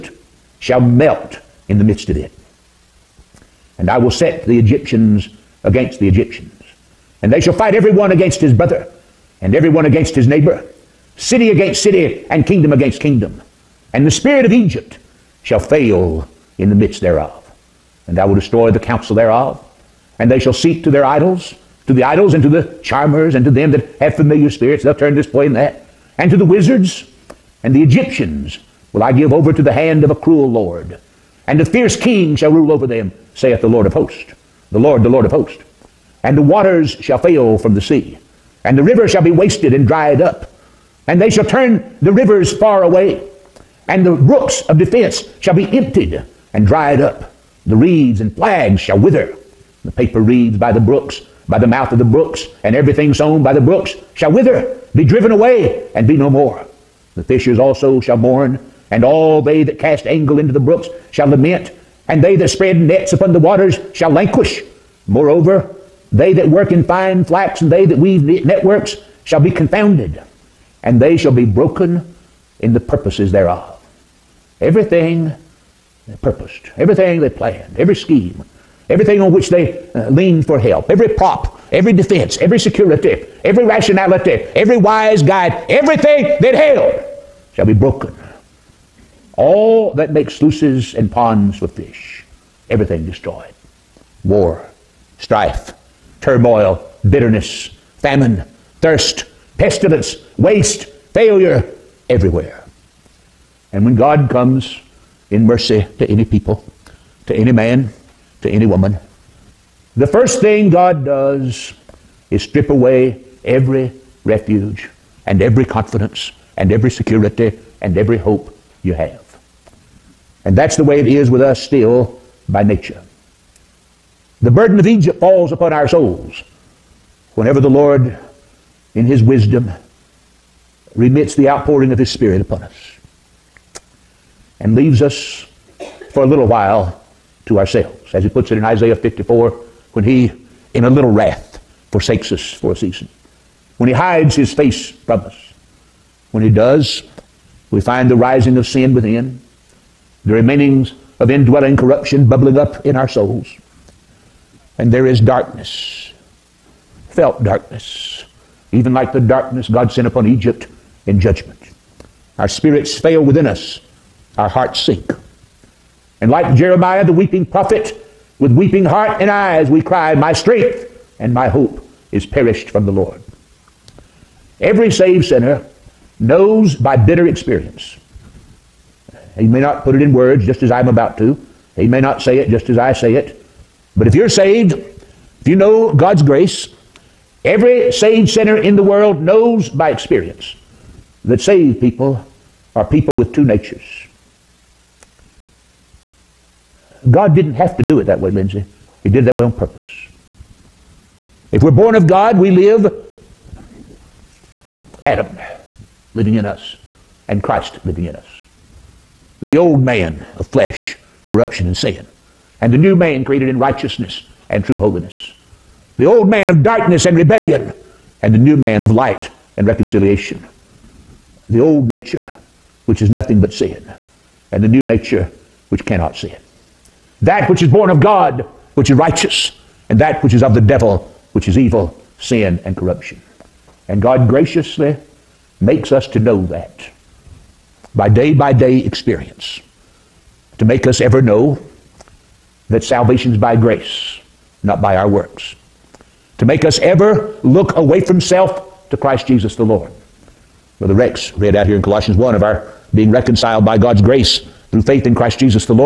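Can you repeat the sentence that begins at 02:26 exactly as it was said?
When he does, we find the rising of sin within, the remainings of indwelling corruption bubbling up in our souls.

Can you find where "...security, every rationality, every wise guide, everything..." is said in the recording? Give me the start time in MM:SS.
01:22.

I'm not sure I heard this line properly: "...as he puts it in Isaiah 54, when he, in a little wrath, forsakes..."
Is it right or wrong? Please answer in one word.
right.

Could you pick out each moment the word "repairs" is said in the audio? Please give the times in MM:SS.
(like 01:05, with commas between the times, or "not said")
not said.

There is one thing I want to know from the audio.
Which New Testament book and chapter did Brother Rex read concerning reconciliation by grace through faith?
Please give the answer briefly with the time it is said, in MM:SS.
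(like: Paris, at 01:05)
Colossians 1, at 04:11.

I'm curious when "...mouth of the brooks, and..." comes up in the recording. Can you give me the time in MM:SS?
00:51.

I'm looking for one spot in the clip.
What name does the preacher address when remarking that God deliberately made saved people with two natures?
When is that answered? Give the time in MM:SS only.
03:18.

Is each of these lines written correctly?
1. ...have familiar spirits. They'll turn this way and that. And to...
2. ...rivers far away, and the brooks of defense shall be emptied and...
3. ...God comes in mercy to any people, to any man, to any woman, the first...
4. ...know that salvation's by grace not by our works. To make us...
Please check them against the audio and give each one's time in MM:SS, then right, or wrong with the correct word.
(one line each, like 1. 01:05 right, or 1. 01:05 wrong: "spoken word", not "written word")
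1. 00:23 right
2. 00:42 right
3. 01:43 right
4. 04:01 right.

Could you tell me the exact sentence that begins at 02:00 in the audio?
And that's the way it is with us still by nature.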